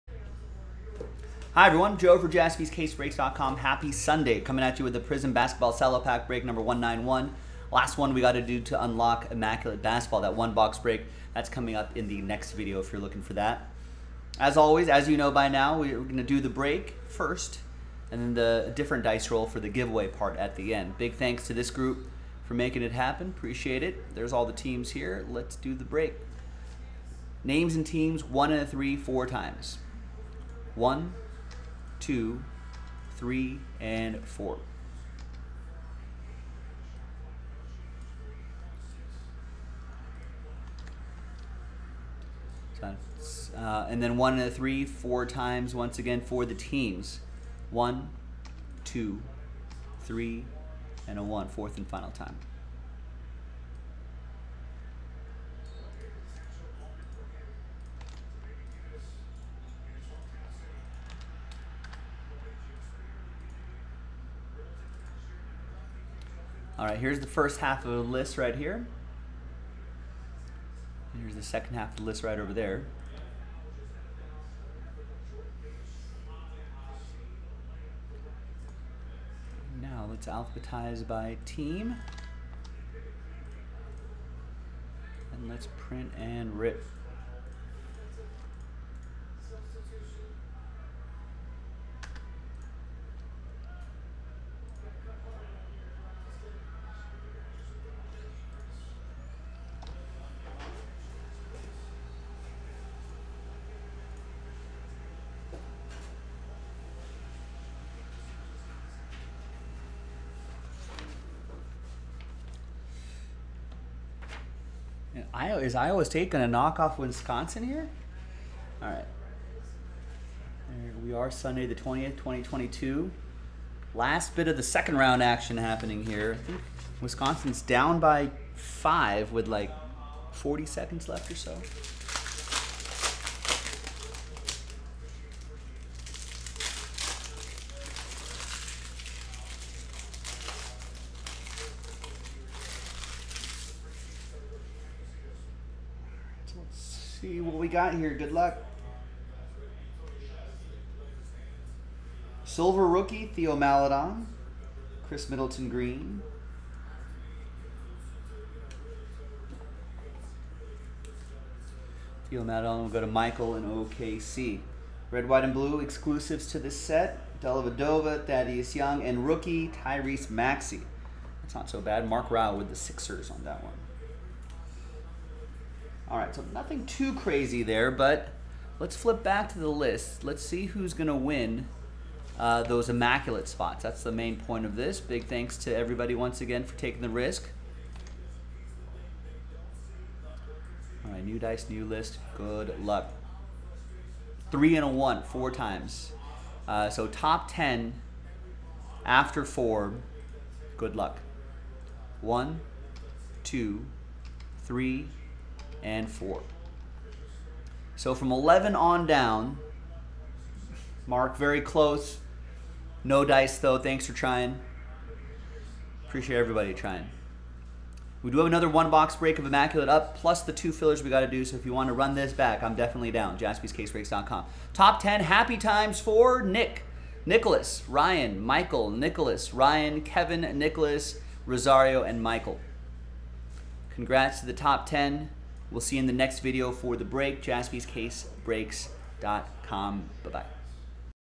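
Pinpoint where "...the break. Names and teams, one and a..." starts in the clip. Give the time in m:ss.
0:25.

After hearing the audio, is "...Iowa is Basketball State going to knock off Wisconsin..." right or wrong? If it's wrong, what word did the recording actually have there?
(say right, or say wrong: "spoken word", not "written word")
wrong: "Iowa", not "Basketball".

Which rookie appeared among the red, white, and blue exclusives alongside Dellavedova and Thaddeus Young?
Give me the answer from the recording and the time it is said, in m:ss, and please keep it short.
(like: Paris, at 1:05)
Tyrese Maxey, at 2:49.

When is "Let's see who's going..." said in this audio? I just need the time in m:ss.
3:00.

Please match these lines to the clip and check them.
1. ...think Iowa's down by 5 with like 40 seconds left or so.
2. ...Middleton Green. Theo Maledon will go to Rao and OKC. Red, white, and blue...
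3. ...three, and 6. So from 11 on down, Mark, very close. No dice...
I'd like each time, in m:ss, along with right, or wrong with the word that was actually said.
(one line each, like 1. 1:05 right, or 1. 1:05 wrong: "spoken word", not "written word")
1. 2:06 wrong: "Wisconsin", not "Iowa"
2. 2:35 wrong: "Michael", not "Rao"
3. 3:24 wrong: "4", not "6".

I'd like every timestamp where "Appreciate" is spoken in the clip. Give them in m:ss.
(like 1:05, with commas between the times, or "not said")
0:23, 3:36.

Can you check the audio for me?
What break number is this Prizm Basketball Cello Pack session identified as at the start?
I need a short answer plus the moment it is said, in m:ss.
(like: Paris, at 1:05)
191, at 0:06.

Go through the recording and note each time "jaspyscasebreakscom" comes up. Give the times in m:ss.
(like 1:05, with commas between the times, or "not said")
0:02, 3:43, 3:57.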